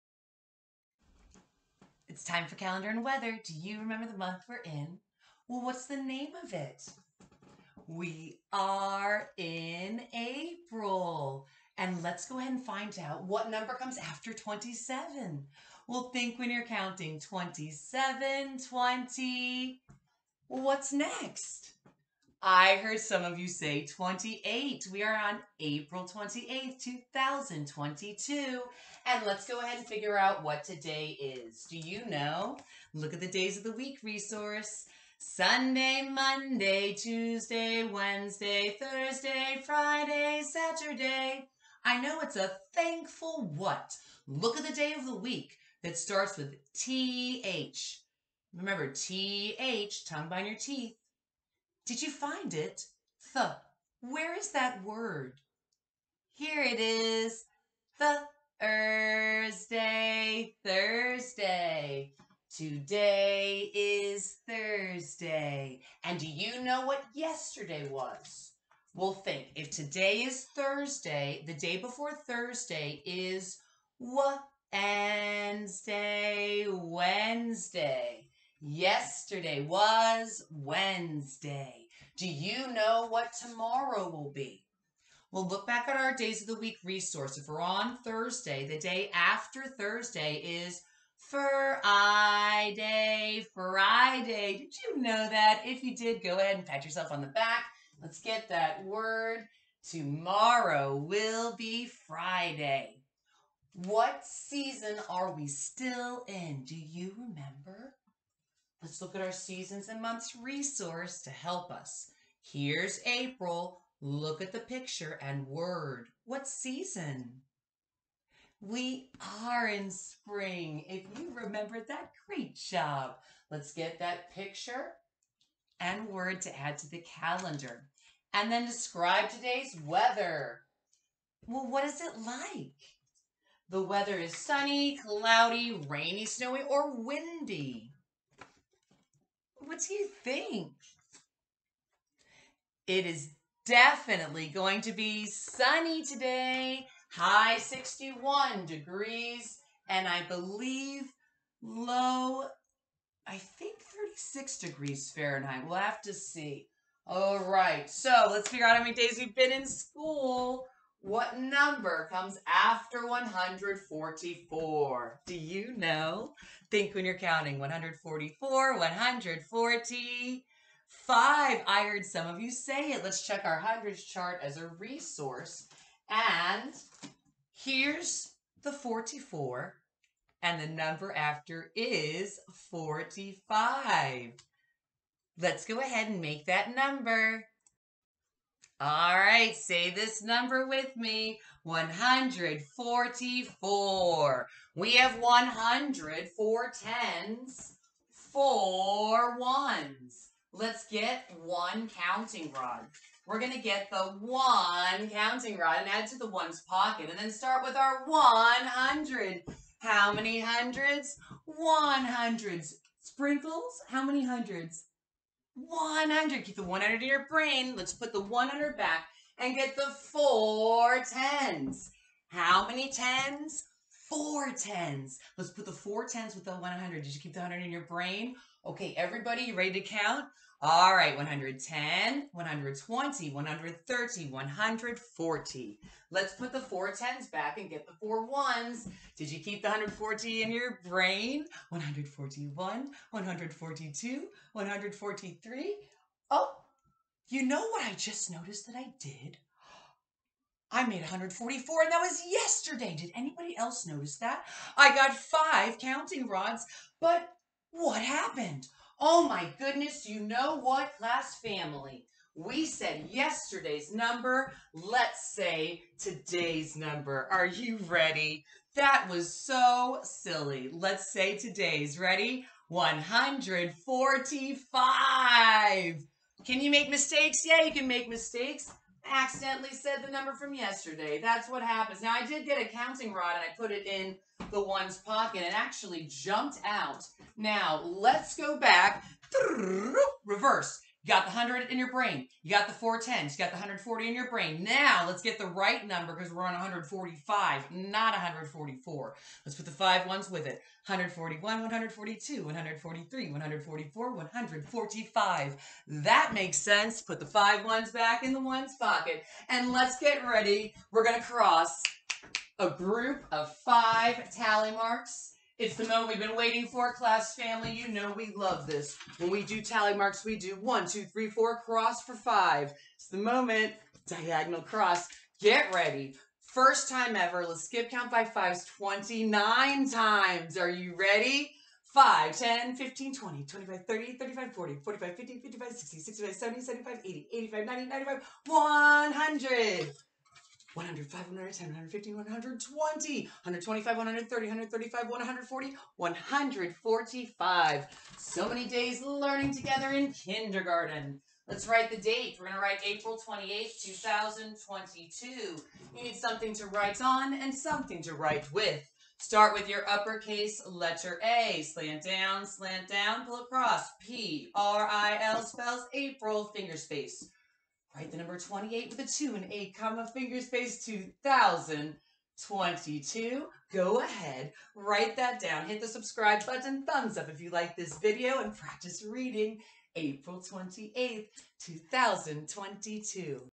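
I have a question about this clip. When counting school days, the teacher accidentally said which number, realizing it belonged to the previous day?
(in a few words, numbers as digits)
144.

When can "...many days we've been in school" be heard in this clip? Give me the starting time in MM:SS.
02:38.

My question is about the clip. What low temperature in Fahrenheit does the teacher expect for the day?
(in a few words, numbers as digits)
36.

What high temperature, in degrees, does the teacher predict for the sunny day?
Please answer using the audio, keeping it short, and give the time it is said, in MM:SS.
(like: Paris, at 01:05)
61, at 02:27.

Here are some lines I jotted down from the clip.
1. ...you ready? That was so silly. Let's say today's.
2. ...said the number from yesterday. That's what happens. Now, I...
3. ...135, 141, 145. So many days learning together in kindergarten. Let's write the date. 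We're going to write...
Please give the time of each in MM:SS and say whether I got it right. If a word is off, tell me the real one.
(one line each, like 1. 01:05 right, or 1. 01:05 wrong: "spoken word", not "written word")
1. 04:27 right
2. 04:39 right
3. 05:44 wrong: "140", not "141".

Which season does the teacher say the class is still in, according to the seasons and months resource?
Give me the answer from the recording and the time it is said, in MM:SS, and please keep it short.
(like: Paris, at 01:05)
spring, at 01:59.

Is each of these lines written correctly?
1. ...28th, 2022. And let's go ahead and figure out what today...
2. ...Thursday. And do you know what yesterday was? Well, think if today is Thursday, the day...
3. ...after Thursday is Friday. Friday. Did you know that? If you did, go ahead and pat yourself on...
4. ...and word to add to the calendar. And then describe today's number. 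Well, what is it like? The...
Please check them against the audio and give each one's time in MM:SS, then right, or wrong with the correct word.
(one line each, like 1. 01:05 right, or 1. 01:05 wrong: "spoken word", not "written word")
1. 00:26 right
2. 01:04 right
3. 01:29 right
4. 02:05 wrong: "weather", not "number".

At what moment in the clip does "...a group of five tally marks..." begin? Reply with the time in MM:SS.
05:12.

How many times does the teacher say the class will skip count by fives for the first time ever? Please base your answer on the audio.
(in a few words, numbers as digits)
29.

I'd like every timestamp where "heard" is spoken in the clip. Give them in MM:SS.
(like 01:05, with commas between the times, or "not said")
00:22, 02:51.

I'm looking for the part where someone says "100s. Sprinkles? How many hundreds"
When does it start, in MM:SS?
03:31.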